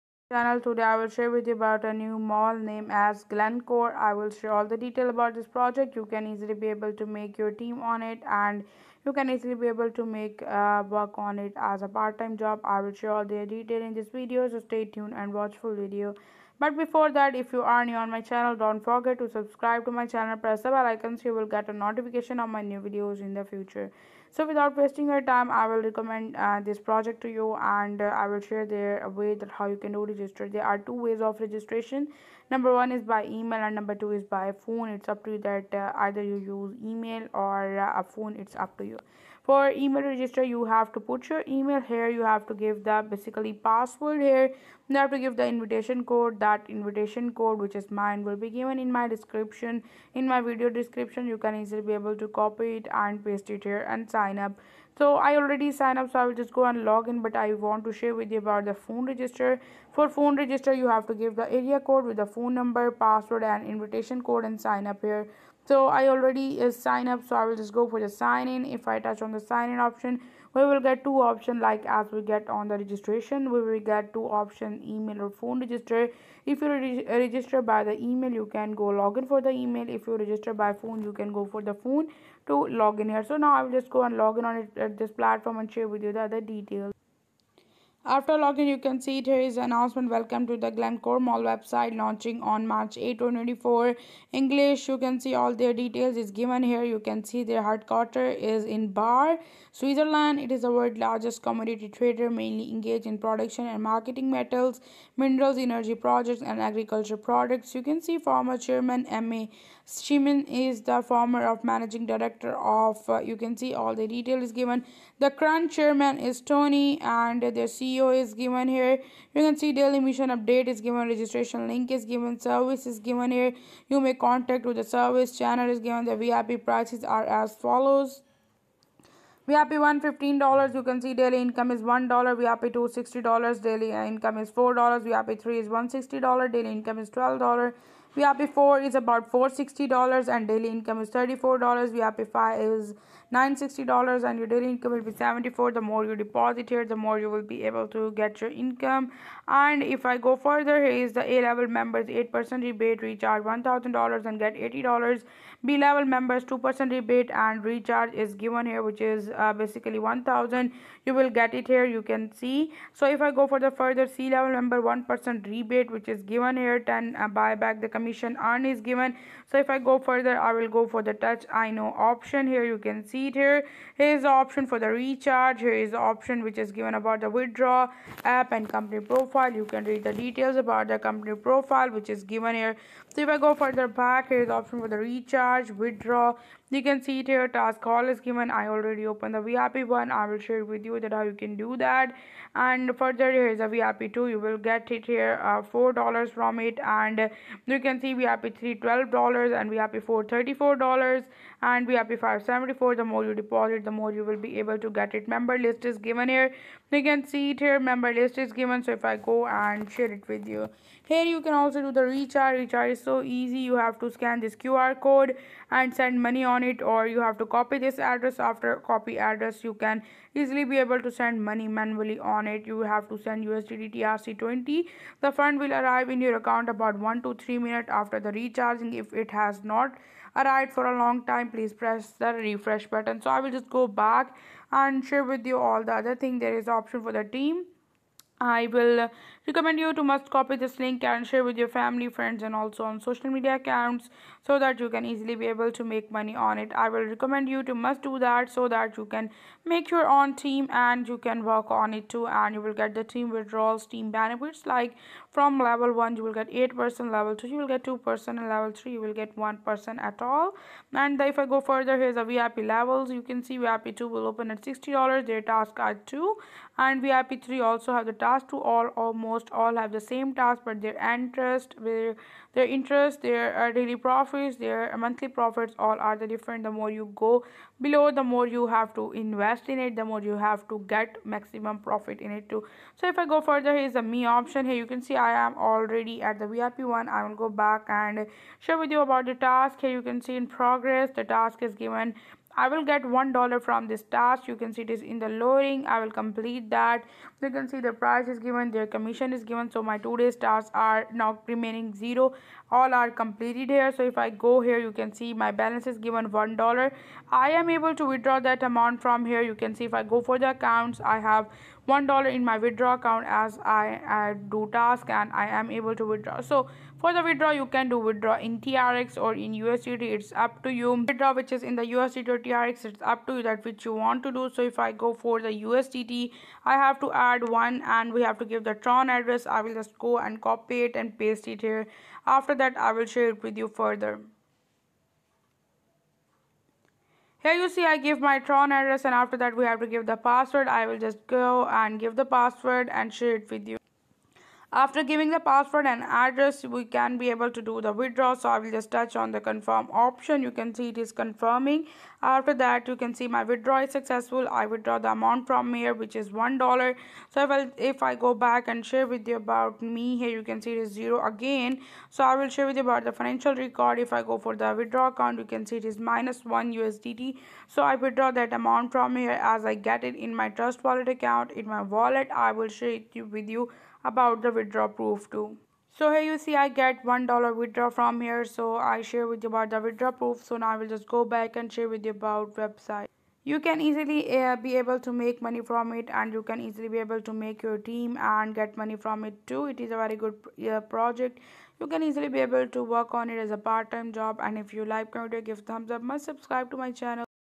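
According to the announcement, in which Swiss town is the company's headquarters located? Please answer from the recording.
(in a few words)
Baar.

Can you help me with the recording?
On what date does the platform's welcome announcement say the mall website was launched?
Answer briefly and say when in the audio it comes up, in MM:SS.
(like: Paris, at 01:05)
March 8, 2024, at 01:32.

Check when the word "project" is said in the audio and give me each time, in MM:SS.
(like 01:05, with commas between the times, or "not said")
00:05, 00:26, 01:45, 06:30.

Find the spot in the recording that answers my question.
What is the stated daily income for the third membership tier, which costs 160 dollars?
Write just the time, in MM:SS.
02:17.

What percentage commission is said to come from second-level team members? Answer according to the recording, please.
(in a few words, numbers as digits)
2%.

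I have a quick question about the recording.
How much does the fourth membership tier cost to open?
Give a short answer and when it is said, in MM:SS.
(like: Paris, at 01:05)
$460, at 02:19.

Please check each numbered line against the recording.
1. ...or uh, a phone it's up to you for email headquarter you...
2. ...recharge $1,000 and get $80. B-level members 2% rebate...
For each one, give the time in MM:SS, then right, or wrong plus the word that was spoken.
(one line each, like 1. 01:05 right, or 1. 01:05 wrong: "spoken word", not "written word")
1. 00:37 wrong: "register", not "headquarter"
2. 02:33 right.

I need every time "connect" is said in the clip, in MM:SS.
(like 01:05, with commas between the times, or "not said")
not said.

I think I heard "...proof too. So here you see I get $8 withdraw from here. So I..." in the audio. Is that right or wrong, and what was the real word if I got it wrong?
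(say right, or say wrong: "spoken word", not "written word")
wrong: "1", not "8".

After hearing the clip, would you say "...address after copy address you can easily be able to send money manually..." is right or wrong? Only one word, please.
right.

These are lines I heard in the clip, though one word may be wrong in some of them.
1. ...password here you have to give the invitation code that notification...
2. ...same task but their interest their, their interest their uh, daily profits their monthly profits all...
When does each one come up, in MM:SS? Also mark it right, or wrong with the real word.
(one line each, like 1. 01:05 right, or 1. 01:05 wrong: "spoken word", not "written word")
1. 00:43 wrong: "invitation", not "notification"
2. 04:30 right.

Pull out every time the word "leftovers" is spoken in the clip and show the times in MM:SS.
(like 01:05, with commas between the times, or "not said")
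not said.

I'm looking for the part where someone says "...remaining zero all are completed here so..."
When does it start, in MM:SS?
05:01.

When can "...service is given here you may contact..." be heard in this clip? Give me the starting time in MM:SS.
02:02.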